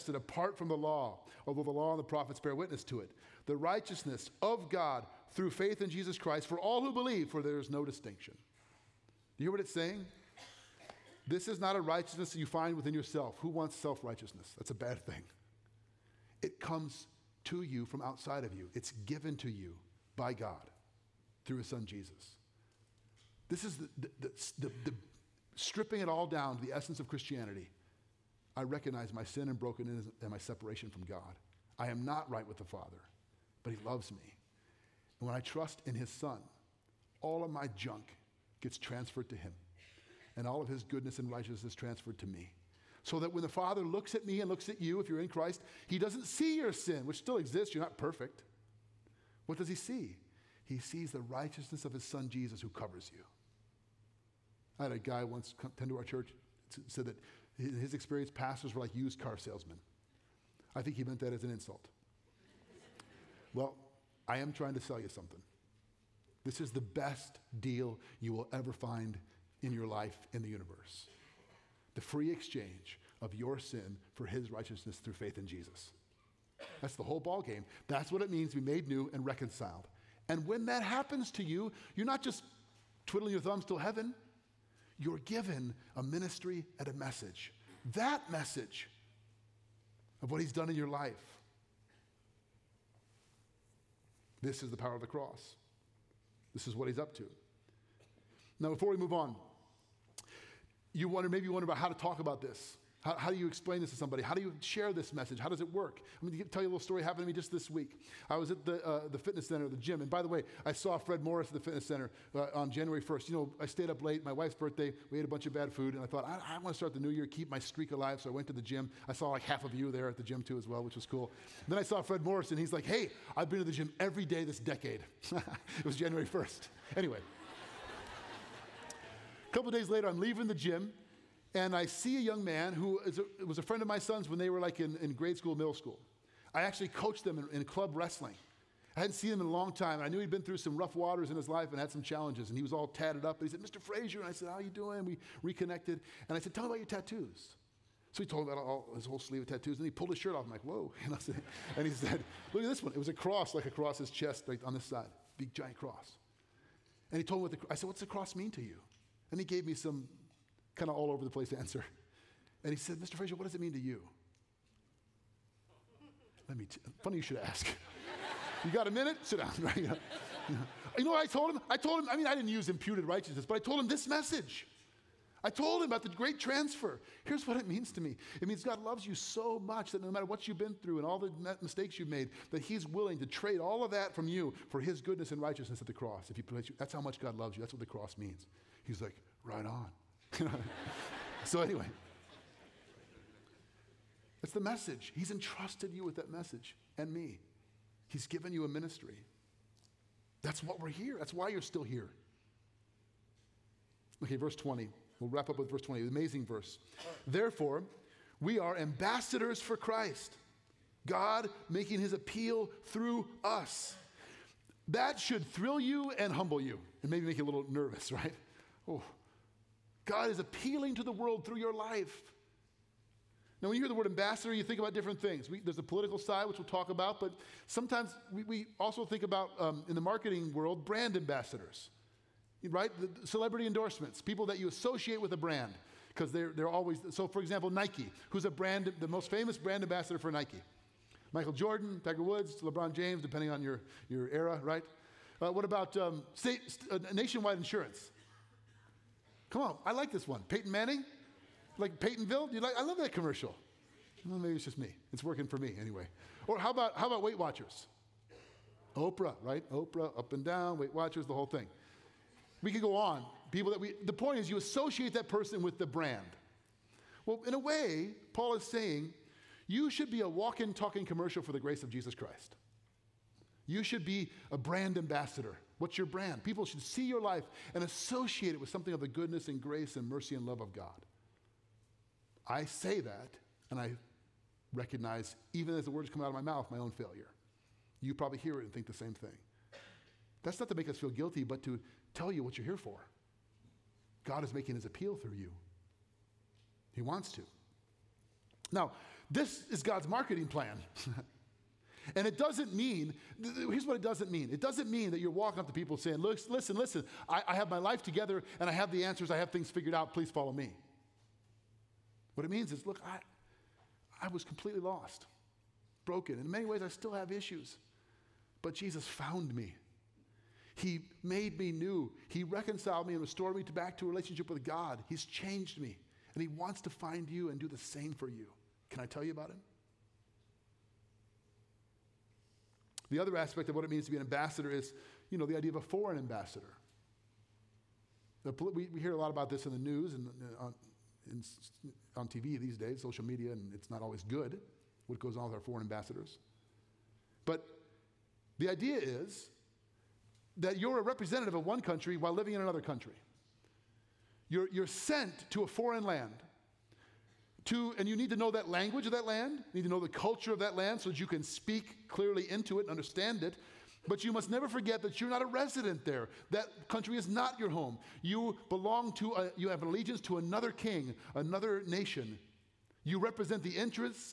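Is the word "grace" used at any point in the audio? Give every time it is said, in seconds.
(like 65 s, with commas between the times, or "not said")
271 s, 279 s.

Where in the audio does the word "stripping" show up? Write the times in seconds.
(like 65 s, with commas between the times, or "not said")
25 s.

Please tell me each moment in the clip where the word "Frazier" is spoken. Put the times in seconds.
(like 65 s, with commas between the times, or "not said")
143 s, 163 s.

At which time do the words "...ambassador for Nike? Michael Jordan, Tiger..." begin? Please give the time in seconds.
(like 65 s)
239 s.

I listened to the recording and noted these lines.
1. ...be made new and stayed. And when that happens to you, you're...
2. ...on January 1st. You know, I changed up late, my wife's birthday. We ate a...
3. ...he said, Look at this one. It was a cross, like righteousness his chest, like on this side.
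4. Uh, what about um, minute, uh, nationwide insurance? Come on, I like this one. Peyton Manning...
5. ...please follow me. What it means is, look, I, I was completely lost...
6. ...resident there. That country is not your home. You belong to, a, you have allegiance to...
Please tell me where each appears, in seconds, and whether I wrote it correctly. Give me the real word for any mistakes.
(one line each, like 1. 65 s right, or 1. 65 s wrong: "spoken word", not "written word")
1. 78 s wrong: "reconciled", not "stayed"
2. 112 s wrong: "stayed", not "changed"
3. 151 s wrong: "across", not "righteousness"
4. 245 s wrong: "state", not "minute"
5. 310 s right
6. 365 s right.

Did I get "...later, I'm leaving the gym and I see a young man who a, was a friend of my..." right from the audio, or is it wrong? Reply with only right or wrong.
right.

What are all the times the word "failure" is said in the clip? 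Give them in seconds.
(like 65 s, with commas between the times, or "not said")
286 s.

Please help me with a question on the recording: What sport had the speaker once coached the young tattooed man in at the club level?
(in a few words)
Wrestling.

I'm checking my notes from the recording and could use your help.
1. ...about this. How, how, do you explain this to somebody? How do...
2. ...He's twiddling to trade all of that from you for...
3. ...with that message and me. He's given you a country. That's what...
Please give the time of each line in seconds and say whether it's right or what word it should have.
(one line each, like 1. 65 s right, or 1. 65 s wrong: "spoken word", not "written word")
1. 102 s right
2. 182 s wrong: "willing", not "twiddling"
3. 196 s wrong: "ministry", not "country".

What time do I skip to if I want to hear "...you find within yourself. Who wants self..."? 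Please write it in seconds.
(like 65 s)
12 s.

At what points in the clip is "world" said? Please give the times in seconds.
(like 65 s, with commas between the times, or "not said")
221 s, 230 s.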